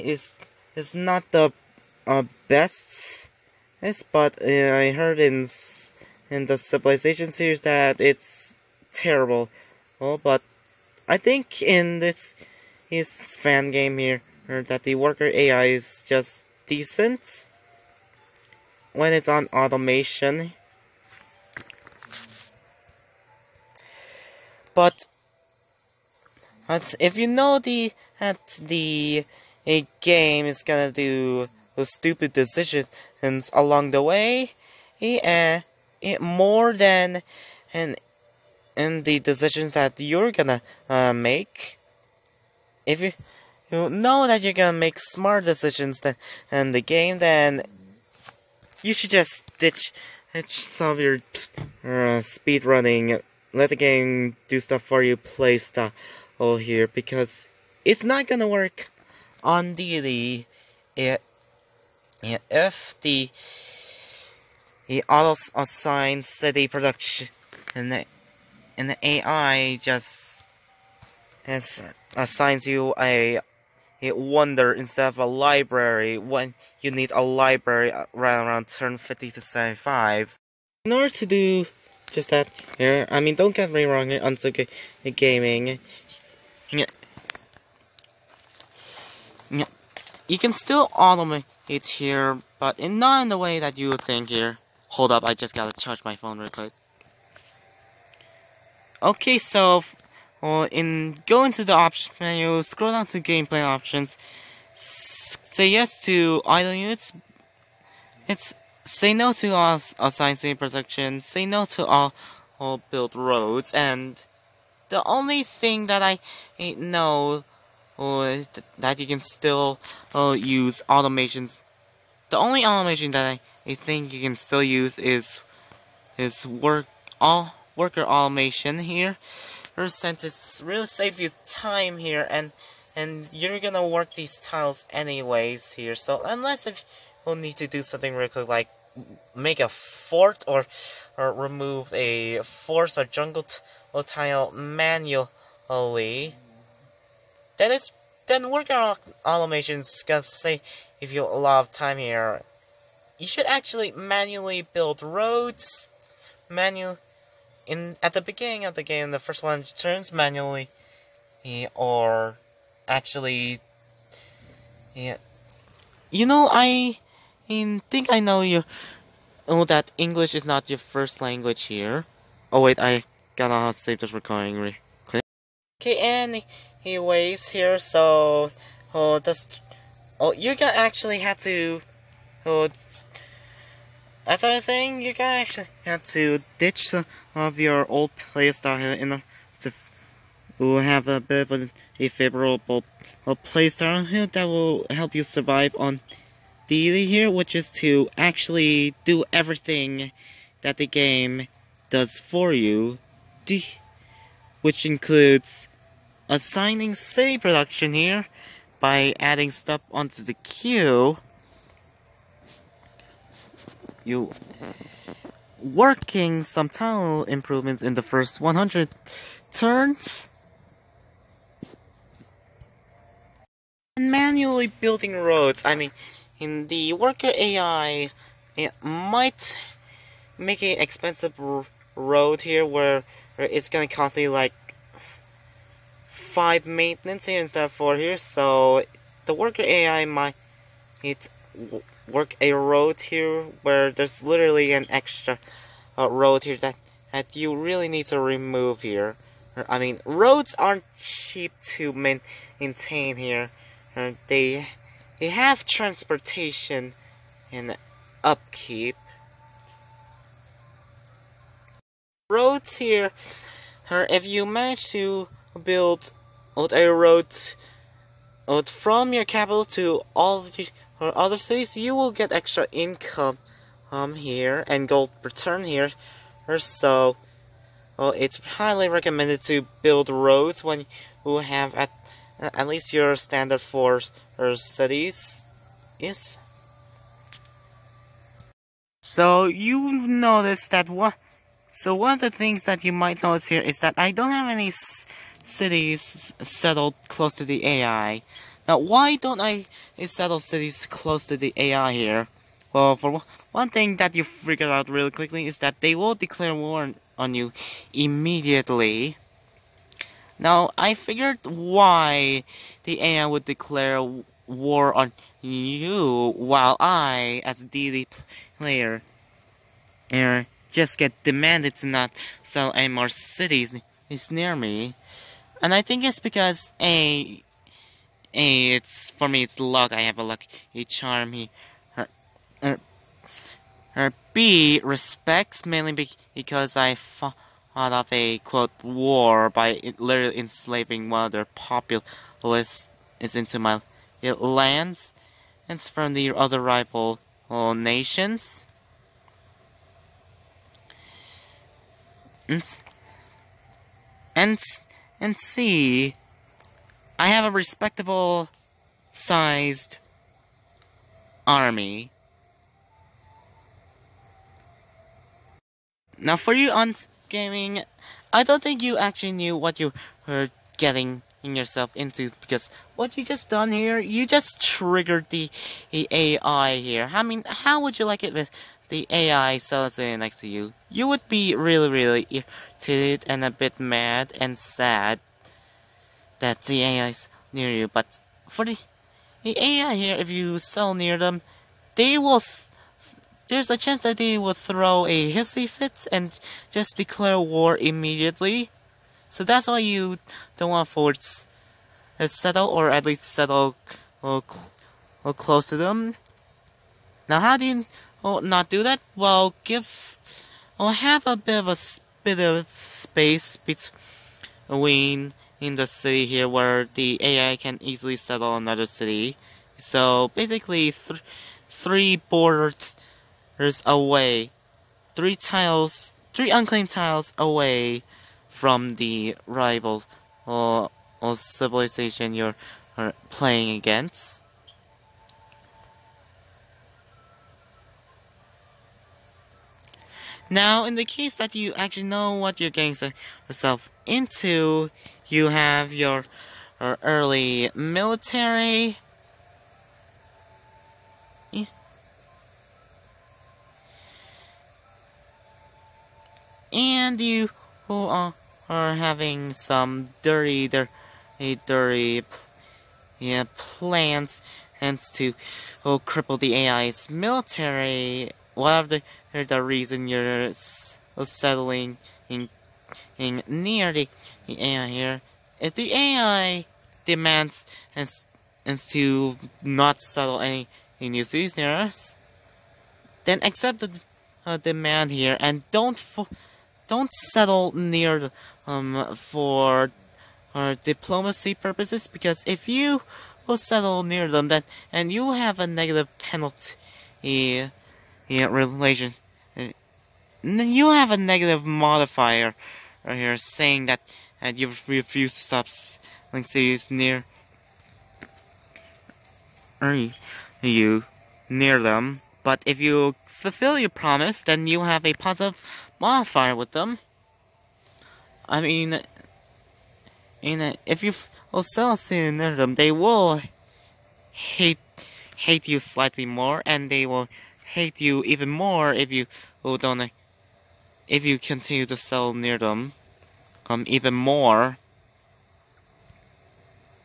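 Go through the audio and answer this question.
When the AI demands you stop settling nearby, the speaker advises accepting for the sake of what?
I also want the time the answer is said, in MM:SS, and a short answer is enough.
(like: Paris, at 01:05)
Diplomacy, at 08:10.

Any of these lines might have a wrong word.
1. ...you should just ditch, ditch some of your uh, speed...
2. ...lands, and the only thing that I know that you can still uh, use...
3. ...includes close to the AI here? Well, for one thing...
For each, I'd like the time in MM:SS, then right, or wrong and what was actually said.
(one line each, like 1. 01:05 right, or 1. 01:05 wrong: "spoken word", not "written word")
1. 00:48 right
2. 01:53 wrong: "roads", not "lands"
3. 05:00 wrong: "cities", not "includes".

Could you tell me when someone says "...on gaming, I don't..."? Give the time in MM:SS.
06:06.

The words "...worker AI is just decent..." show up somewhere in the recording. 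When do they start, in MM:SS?
00:14.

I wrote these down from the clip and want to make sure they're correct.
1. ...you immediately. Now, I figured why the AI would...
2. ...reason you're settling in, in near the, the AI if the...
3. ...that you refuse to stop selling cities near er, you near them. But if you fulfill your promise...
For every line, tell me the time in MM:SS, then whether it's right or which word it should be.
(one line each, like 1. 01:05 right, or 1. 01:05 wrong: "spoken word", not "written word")
1. 05:07 right
2. 07:49 right
3. 08:24 right.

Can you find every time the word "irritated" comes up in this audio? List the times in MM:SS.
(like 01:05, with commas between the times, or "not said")
06:22.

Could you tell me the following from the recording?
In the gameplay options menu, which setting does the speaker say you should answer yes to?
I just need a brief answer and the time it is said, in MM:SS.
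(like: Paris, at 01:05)
Idle units, at 01:46.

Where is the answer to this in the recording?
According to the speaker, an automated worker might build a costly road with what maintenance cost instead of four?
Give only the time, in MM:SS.
03:56.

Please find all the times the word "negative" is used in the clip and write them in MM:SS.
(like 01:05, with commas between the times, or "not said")
08:15, 08:21.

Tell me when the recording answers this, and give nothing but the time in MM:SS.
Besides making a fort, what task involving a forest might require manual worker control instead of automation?
02:21.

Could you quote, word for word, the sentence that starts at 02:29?
automations gonna say if you of time here.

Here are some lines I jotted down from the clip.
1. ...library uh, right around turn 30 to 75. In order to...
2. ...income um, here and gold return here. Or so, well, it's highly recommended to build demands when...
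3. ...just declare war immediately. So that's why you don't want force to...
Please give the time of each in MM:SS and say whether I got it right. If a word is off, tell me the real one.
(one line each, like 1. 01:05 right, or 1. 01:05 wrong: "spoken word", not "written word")
1. 01:17 wrong: "50", not "30"
2. 04:32 wrong: "roads", not "demands"
3. 06:36 right.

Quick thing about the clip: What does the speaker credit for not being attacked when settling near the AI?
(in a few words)
A lucky charm.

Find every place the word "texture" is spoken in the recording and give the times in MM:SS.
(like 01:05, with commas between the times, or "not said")
not said.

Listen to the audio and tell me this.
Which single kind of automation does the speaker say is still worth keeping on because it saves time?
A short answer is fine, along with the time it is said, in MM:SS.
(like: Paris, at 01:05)
Worker automation, at 02:06.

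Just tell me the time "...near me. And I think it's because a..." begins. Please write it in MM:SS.
05:24.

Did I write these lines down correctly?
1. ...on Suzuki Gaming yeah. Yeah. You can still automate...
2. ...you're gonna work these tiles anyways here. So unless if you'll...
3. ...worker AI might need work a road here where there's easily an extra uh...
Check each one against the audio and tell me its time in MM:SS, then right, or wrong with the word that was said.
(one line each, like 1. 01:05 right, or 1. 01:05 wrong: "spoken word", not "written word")
1. 01:24 right
2. 02:13 right
3. 03:59 wrong: "literally", not "easily".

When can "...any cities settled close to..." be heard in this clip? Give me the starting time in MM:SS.
04:54.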